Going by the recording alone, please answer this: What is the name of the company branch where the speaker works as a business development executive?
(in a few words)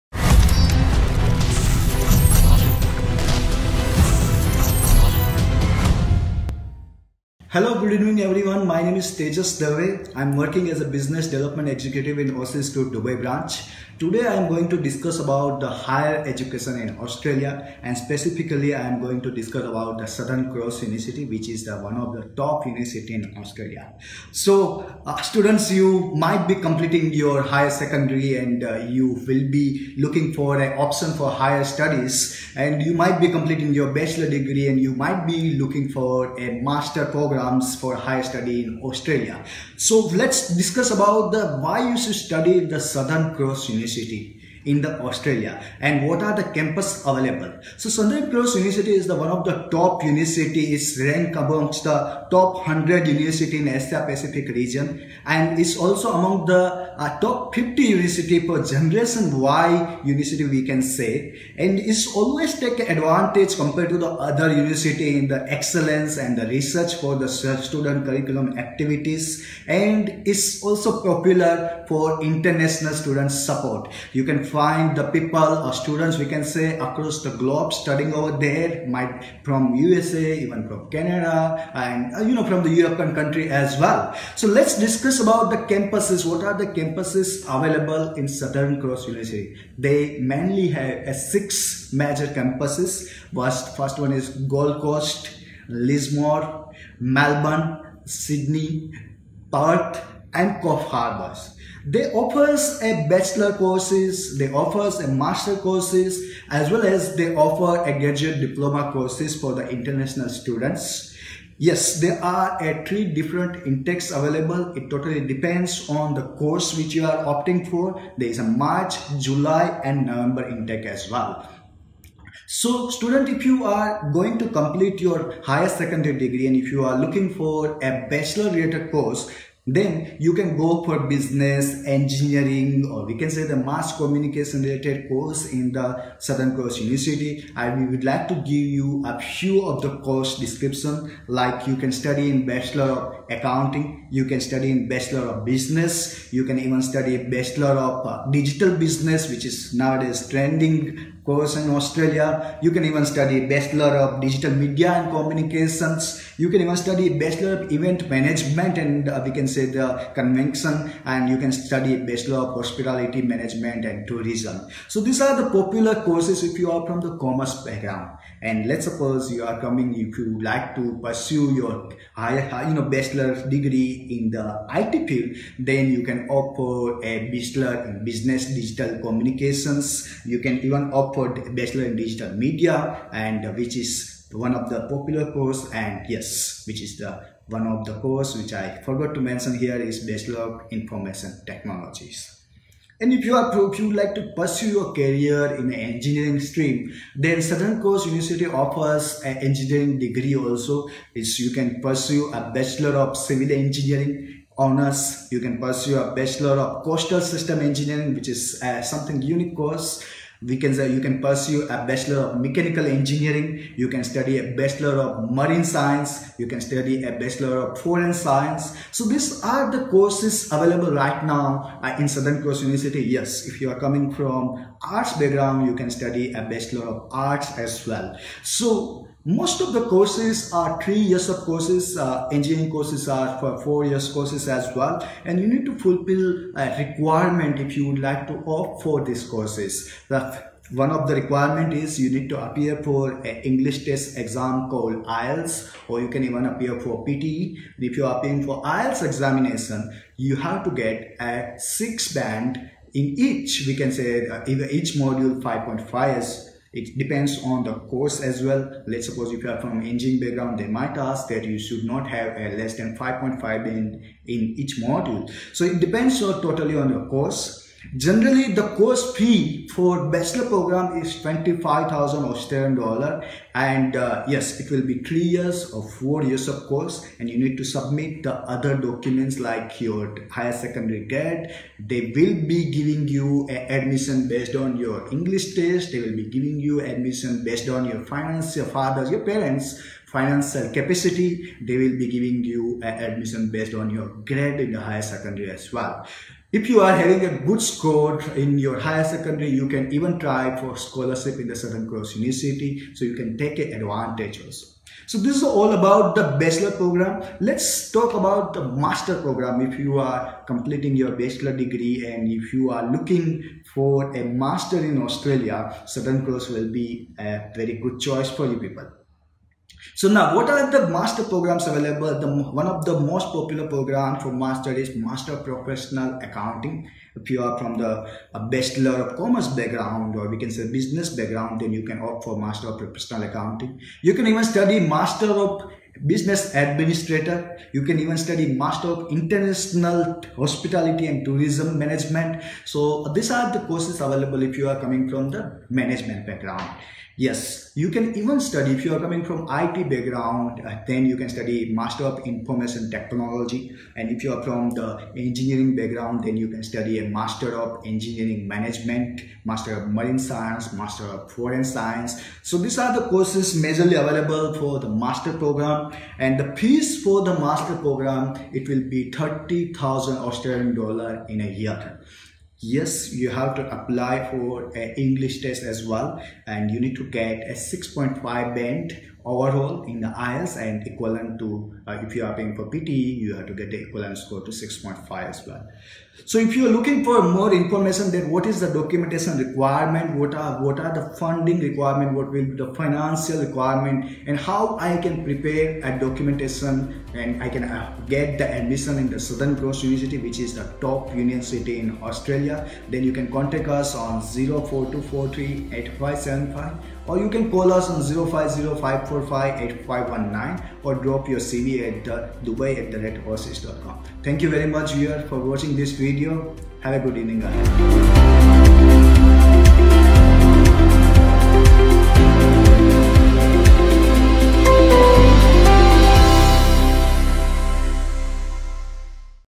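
Aussizz Dubai.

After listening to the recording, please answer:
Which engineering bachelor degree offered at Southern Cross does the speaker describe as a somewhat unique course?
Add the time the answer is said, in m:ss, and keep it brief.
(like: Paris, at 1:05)
Coastal System Engineering, at 3:26.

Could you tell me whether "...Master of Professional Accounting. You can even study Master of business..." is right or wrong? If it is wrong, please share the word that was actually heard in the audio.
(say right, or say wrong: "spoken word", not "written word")
right.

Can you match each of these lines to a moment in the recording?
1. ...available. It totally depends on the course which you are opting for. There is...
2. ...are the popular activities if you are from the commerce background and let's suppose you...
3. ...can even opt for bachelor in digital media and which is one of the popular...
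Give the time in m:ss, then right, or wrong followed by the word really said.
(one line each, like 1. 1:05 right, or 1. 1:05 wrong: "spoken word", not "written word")
1. 1:54 right
2. 2:45 wrong: "courses", not "activities"
3. 3:00 right.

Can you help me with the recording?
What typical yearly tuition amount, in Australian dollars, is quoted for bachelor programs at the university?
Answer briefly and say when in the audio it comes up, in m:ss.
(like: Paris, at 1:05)
25,000, at 4:31.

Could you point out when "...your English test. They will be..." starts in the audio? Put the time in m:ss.
4:44.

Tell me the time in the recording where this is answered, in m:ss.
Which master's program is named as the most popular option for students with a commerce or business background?
5:24.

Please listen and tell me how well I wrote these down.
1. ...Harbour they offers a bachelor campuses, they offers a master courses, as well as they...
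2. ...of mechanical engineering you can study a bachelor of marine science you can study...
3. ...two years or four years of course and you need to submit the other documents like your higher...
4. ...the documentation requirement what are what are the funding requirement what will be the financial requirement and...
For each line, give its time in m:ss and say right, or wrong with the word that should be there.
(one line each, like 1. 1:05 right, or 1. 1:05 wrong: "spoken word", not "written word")
1. 1:40 wrong: "courses", not "campuses"
2. 3:32 right
3. 4:34 wrong: "three", not "two"
4. 6:28 right.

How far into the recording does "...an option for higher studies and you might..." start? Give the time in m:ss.
0:30.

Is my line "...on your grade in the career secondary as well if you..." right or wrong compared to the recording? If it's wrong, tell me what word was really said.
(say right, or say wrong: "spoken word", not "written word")
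wrong: "higher", not "career".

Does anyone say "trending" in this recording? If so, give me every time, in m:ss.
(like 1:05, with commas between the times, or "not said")
2:30.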